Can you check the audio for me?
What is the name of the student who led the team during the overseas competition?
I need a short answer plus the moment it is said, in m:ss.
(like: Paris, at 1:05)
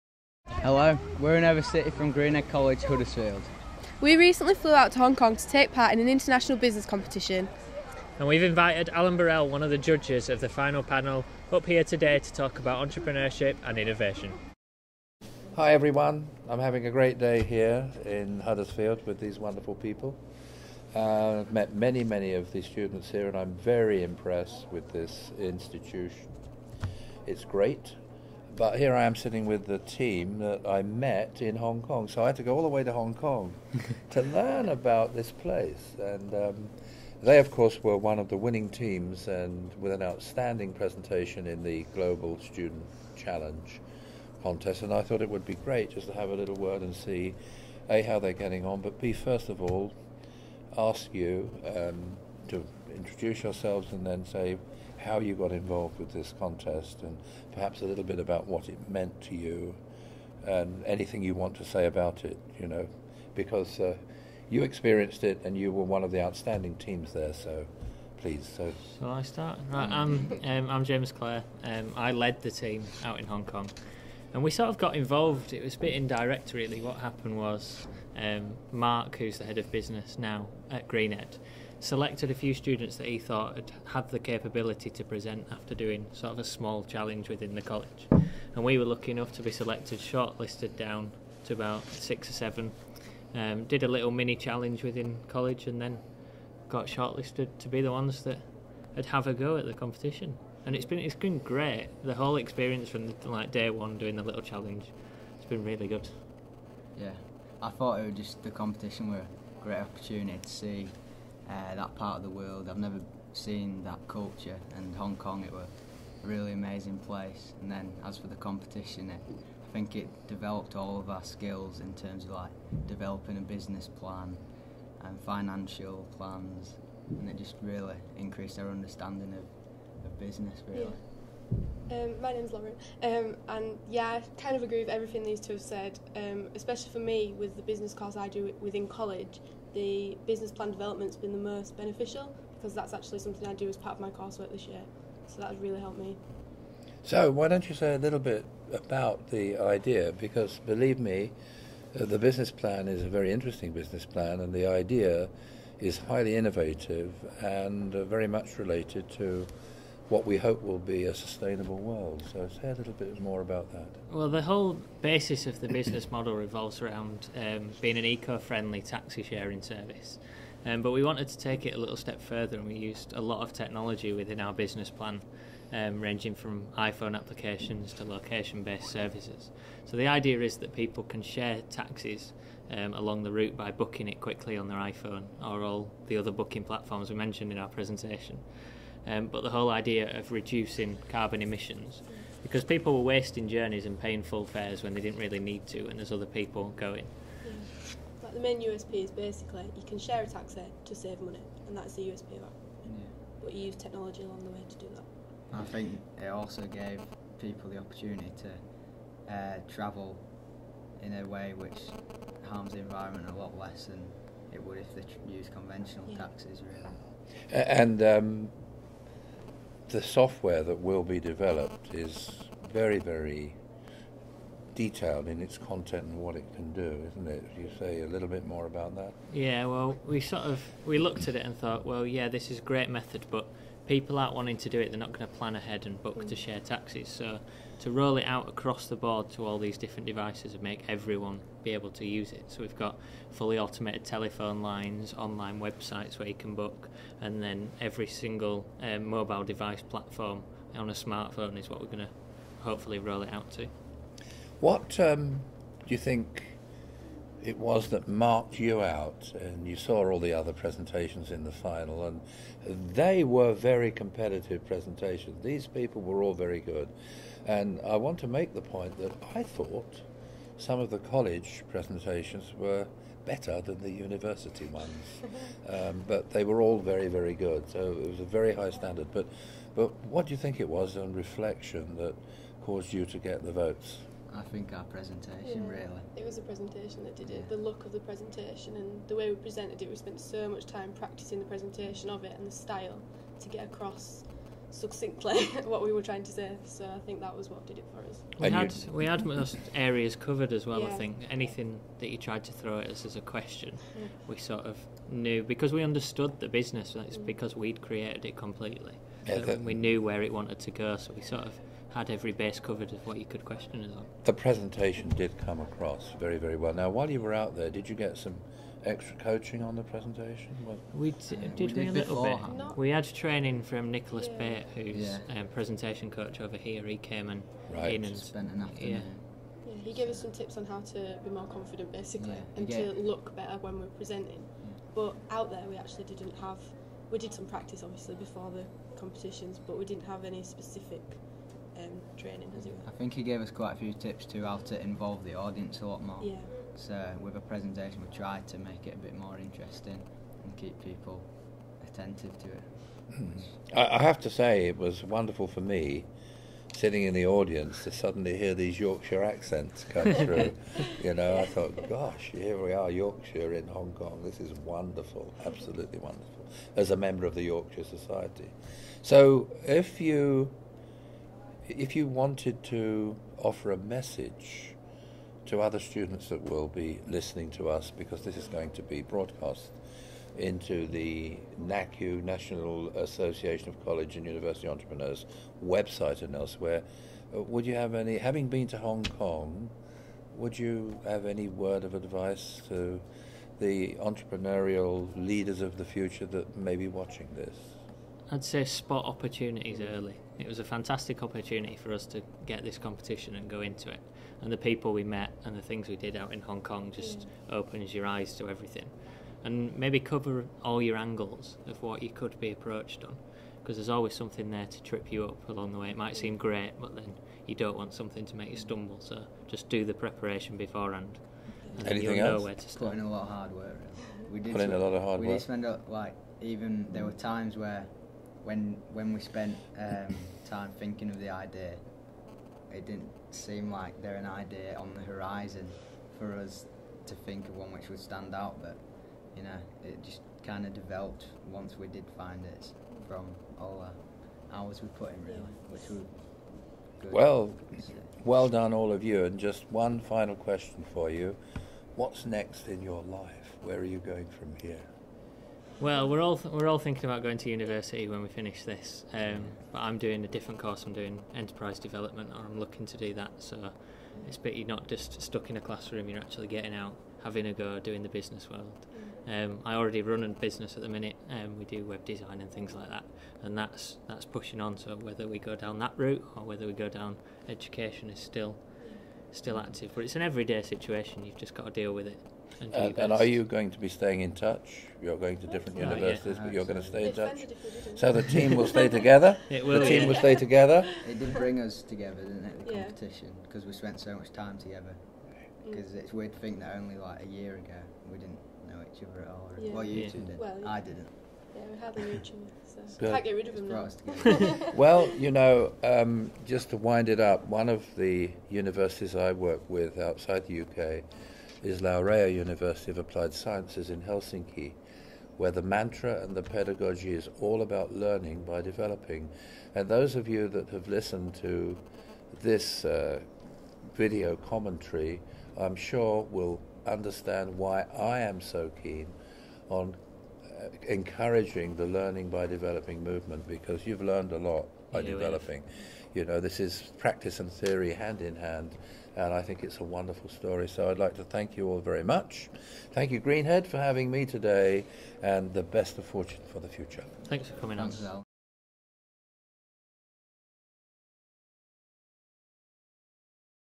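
James Clare, at 1:10.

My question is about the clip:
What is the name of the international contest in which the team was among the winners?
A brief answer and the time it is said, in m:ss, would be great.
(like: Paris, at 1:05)
Global Student Challenge, at 0:41.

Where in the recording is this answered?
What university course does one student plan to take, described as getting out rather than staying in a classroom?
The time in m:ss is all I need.
7:41.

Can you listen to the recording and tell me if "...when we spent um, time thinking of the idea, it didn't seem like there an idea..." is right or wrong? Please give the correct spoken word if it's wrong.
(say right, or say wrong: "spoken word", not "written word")
right.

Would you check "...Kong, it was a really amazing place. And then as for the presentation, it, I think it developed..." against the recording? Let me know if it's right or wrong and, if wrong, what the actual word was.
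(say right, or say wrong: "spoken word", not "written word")
wrong: "competition", not "presentation".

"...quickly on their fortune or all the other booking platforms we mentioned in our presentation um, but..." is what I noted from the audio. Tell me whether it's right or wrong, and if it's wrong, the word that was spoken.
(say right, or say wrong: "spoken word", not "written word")
wrong: "iPhone", not "fortune".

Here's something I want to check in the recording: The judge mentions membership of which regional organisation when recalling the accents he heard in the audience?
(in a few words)
Yorkshire Society.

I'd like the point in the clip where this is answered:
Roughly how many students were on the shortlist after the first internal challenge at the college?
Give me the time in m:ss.
1:31.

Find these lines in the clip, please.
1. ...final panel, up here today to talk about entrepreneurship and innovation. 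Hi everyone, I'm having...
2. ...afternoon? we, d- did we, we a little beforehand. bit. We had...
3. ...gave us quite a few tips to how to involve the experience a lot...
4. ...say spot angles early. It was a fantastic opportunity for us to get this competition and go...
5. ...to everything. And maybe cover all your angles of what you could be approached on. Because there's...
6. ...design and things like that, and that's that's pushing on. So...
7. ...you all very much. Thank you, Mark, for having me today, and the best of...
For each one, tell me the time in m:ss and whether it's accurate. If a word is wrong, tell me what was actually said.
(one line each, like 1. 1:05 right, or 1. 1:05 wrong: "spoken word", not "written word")
1. 0:10 right
2. 5:19 wrong: "presentation", not "afternoon"
3. 5:43 wrong: "audience", not "experience"
4. 6:38 wrong: "opportunities", not "angles"
5. 6:48 right
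6. 7:52 right
7. 9:01 wrong: "Greenhead", not "Mark".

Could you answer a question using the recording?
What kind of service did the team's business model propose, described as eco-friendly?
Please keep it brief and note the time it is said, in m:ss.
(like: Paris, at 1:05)
Taxi sharing service, at 2:48.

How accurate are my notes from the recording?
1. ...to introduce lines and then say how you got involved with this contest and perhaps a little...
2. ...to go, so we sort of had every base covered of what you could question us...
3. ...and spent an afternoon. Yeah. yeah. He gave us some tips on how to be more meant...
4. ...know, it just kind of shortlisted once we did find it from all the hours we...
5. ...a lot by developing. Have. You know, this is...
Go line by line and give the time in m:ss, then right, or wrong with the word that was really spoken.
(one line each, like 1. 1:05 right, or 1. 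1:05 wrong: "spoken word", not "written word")
1. 0:52 wrong: "yourselves", not "lines"
2. 5:10 right
3. 5:28 wrong: "confident", not "meant"
4. 7:19 wrong: "developed", not "shortlisted"
5. 8:54 right.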